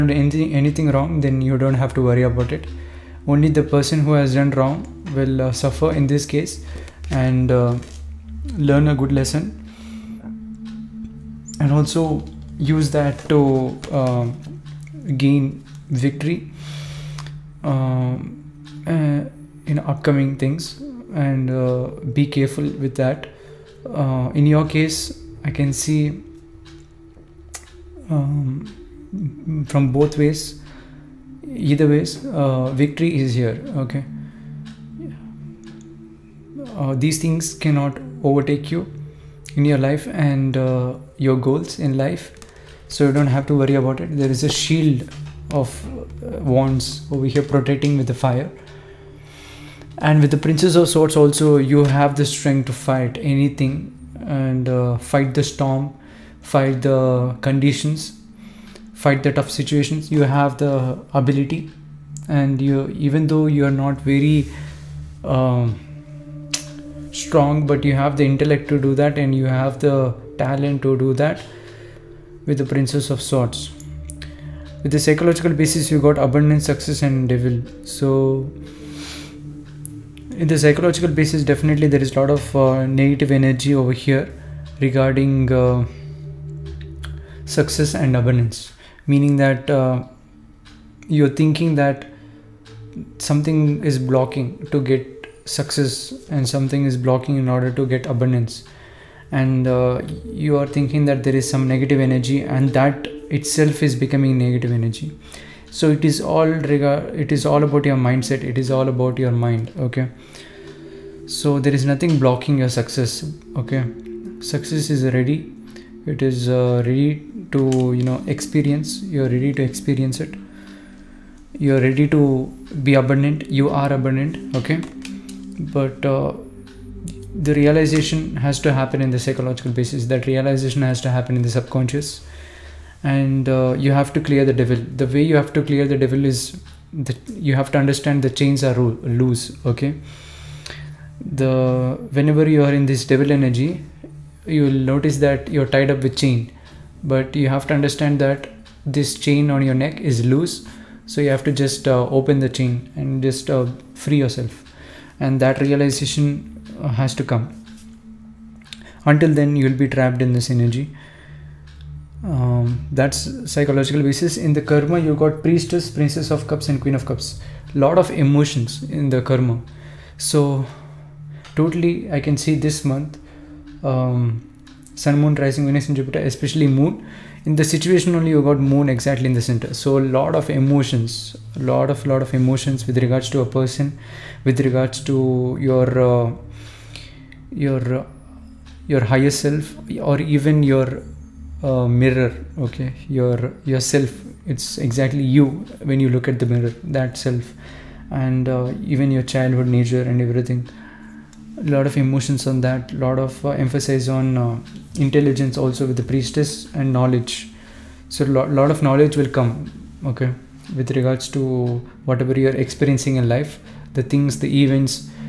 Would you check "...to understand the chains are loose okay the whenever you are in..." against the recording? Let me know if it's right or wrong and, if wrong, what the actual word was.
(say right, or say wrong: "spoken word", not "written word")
right.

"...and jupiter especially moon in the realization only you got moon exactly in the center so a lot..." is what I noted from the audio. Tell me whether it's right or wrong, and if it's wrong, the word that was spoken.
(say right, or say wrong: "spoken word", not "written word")
wrong: "situation", not "realization".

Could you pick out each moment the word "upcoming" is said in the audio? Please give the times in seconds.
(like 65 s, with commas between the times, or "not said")
19 s.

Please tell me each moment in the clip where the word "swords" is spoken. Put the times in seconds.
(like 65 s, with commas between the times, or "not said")
50 s, 73 s.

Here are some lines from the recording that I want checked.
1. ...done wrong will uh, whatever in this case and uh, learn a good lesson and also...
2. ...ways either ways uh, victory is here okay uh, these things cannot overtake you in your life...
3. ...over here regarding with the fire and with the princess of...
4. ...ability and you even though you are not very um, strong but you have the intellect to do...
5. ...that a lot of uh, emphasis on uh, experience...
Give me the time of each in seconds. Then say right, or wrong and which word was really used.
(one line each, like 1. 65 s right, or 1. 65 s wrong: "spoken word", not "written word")
1. 4 s wrong: "suffer", not "whatever"
2. 30 s right
3. 47 s wrong: "protecting", not "regarding"
4. 61 s right
5. 202 s wrong: "intelligence", not "experience".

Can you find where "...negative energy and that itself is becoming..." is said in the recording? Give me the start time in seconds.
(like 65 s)
101 s.